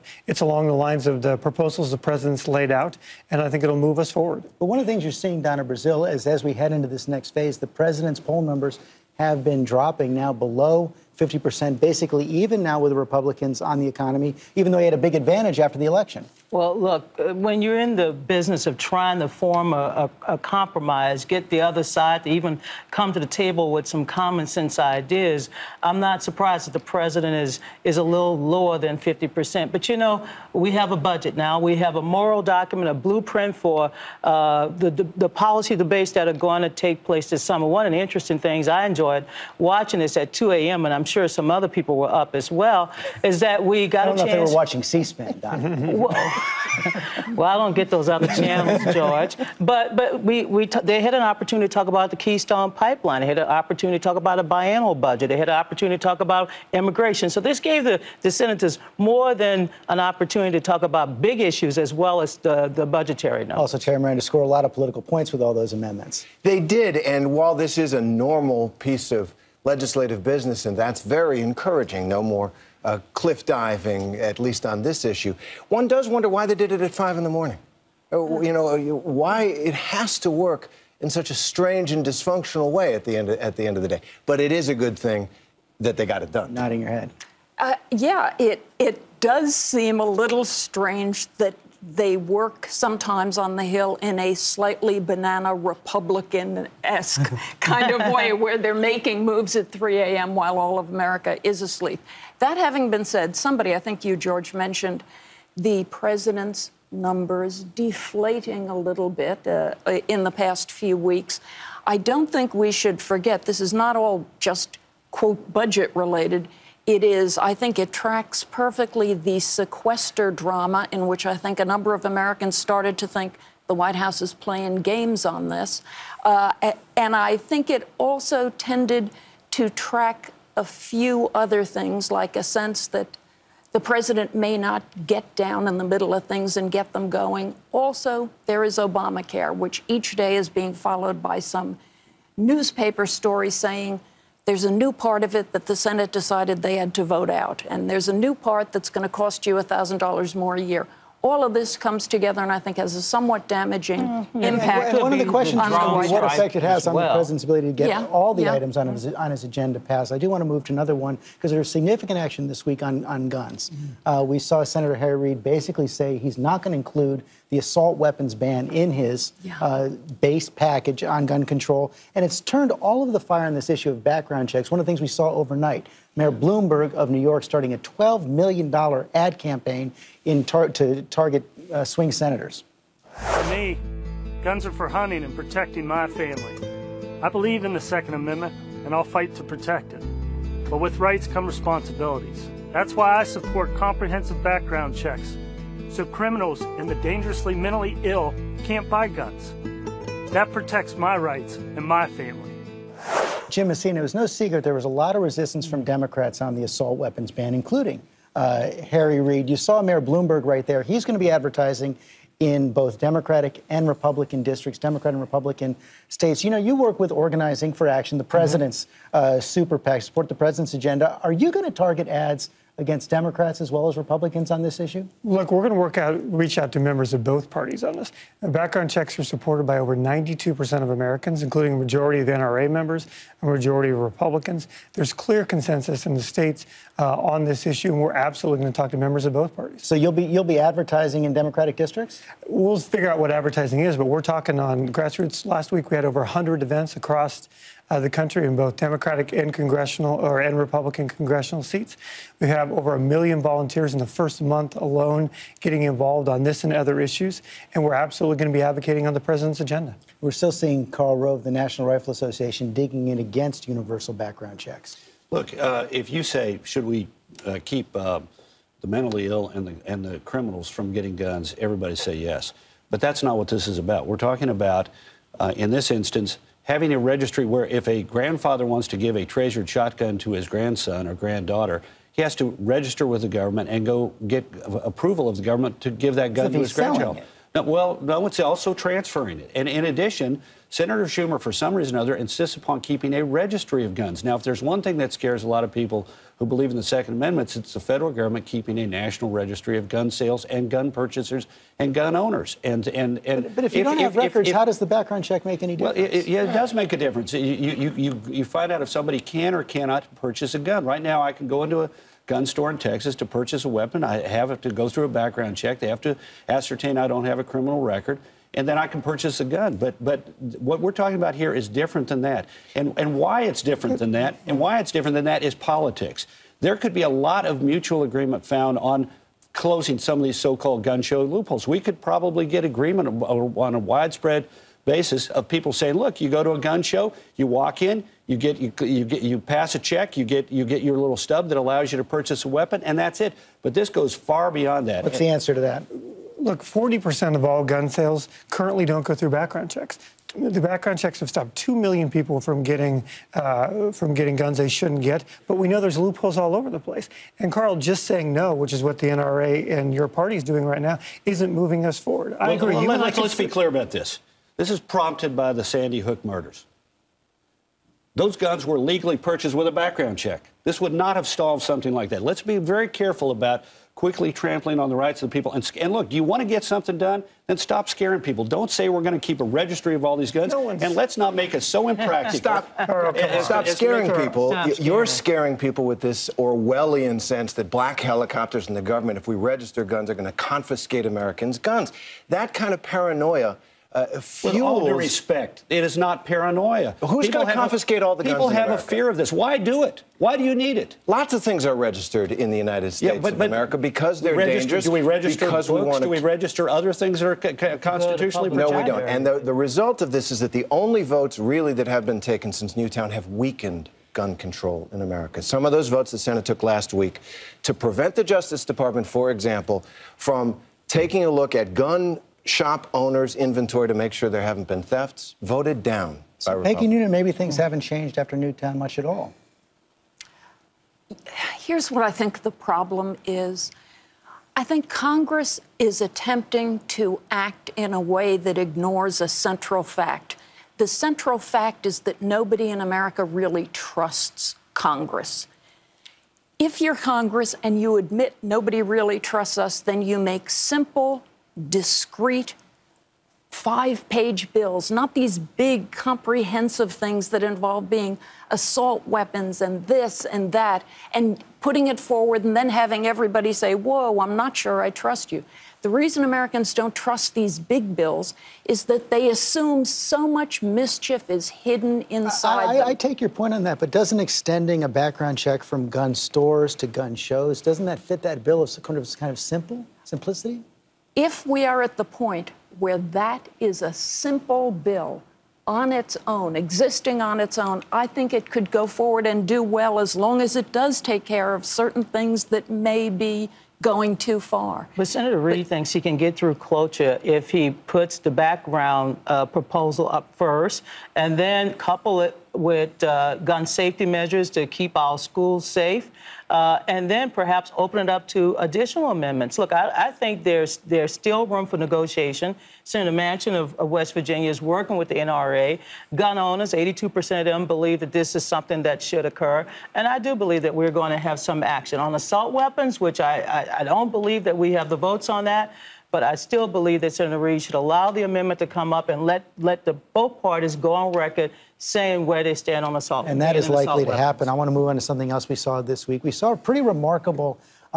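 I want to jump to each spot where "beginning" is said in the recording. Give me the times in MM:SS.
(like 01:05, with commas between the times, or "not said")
not said.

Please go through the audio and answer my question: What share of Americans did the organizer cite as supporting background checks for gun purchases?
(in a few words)
92%.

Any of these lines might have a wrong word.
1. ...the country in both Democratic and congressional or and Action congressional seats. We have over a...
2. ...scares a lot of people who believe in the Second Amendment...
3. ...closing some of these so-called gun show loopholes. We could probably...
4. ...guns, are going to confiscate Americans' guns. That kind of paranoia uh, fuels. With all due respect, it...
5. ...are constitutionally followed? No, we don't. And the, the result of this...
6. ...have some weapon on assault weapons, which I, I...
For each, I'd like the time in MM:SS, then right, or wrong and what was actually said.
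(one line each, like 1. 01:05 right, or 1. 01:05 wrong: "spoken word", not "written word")
1. 04:07 wrong: "Republican", not "Action"
2. 04:55 right
3. 05:29 right
4. 06:29 right
5. 06:47 wrong: "protected", not "followed"
6. 08:41 wrong: "action", not "weapon".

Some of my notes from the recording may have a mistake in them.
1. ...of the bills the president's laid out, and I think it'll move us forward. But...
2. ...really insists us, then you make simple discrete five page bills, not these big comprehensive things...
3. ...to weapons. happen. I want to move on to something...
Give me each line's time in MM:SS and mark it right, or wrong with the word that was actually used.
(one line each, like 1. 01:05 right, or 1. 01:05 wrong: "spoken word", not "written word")
1. 00:01 wrong: "proposals", not "bills"
2. 07:28 wrong: "trusts", not "insists"
3. 08:54 right.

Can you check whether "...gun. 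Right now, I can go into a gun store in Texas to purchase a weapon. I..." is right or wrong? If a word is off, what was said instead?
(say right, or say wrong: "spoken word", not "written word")
right.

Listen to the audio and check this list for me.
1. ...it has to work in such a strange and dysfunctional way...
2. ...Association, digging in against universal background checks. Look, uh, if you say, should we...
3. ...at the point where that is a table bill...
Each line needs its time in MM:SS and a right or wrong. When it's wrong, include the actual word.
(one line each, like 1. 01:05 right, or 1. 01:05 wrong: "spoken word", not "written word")
1. 01:19 right
2. 04:22 right
3. 08:01 wrong: "simple", not "table".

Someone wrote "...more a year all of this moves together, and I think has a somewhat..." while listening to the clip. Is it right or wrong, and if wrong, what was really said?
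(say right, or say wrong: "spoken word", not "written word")
wrong: "comes", not "moves".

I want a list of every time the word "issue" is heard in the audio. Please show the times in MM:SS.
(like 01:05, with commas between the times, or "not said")
01:01, 01:15, 02:53, 03:44, 03:57, 04:16.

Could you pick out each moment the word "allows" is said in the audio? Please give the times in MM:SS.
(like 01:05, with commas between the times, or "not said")
05:41, 08:47.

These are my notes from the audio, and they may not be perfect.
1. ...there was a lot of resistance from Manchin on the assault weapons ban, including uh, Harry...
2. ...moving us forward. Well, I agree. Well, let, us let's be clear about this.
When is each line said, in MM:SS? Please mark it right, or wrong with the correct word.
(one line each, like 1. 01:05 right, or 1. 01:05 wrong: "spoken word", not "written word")
1. 03:24 wrong: "Democrats", not "Manchin"
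2. 06:01 right.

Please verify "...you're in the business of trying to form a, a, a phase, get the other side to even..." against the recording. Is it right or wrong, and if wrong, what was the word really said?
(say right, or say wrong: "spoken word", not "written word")
wrong: "compromise", not "phase".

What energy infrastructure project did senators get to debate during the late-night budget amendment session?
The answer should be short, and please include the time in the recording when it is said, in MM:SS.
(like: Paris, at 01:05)
Keystone Pipeline, at 00:52.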